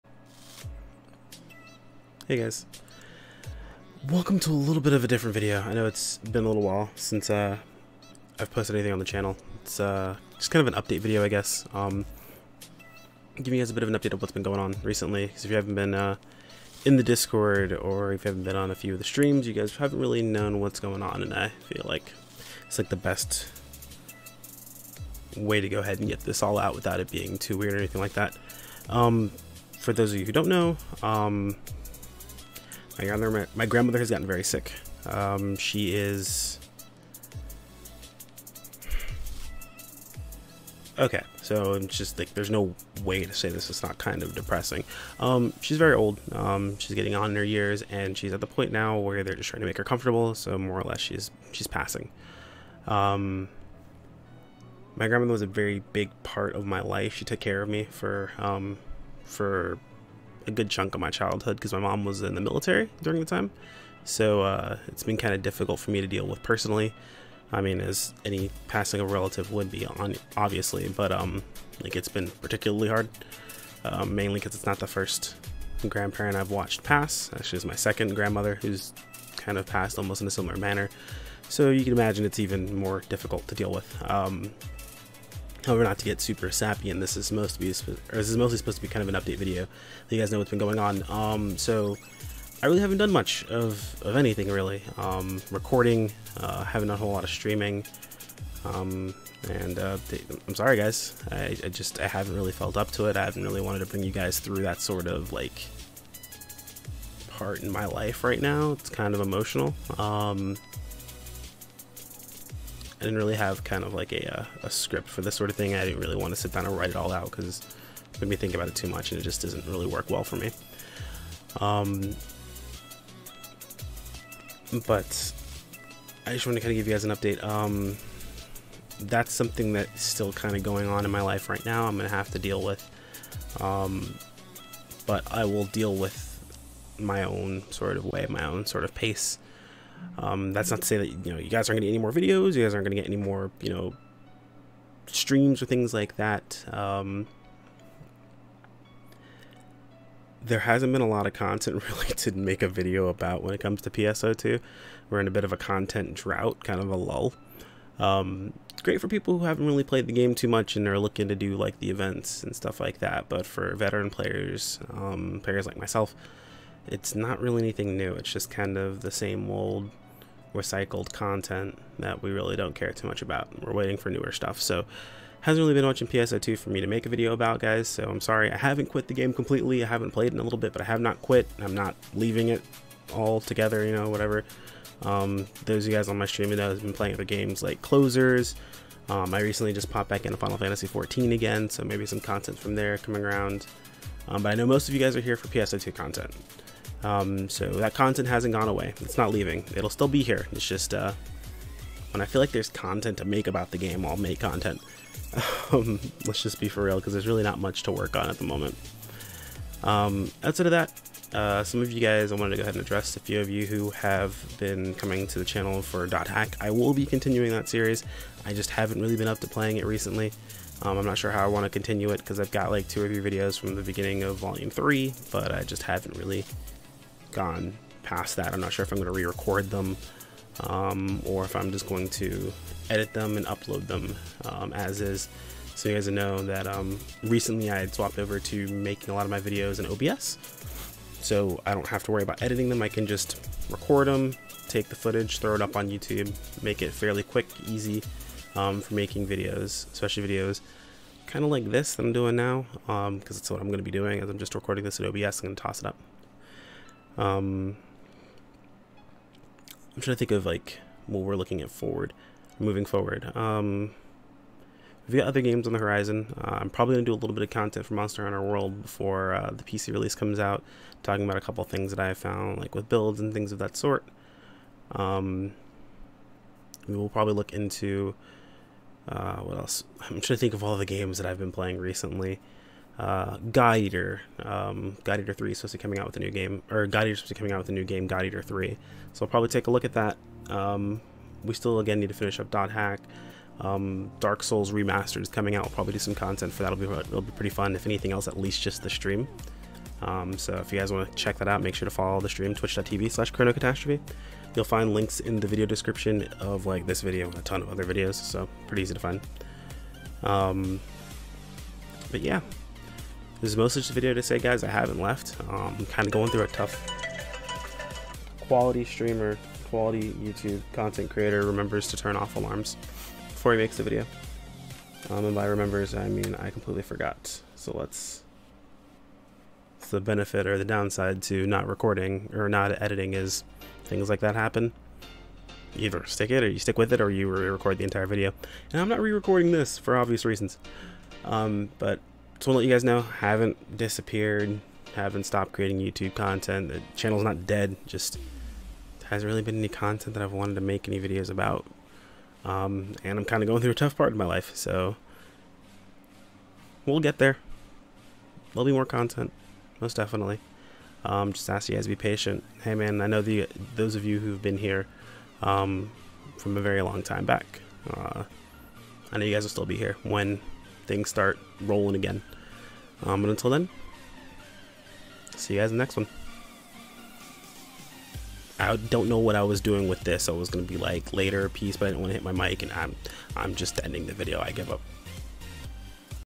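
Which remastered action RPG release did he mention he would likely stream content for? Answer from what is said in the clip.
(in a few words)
Dark Souls Remastered.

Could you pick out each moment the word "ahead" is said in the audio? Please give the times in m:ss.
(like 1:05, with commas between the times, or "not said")
0:25, 3:32.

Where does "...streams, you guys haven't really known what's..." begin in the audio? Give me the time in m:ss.
0:19.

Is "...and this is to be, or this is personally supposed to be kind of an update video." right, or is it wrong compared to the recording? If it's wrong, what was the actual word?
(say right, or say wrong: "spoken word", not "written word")
wrong: "mostly", not "personally".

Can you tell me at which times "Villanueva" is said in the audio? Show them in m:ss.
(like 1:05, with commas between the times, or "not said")
not said.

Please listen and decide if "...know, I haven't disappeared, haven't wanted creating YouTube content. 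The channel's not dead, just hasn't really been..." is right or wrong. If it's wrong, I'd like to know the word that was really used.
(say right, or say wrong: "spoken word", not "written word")
wrong: "stopped", not "wanted".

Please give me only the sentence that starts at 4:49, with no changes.
So I'll probably take a look at that.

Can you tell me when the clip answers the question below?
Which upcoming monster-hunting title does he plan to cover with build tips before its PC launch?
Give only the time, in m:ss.
4:27.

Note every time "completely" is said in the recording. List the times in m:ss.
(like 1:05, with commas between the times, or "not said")
2:59, 5:26.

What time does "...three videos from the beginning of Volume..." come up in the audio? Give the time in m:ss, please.
3:43.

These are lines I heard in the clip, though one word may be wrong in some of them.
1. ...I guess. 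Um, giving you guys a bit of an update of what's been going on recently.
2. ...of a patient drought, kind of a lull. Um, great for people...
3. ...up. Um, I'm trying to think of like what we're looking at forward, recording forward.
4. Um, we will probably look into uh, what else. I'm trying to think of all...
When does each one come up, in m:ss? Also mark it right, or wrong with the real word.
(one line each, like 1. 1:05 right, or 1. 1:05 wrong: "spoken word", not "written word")
1. 0:11 right
2. 2:35 wrong: "content", not "patient"
3. 4:15 wrong: "moving", not "recording"
4. 4:34 right.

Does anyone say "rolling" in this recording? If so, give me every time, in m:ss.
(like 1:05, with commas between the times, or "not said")
6:11.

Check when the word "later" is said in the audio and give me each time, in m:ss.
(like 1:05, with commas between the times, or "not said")
6:21.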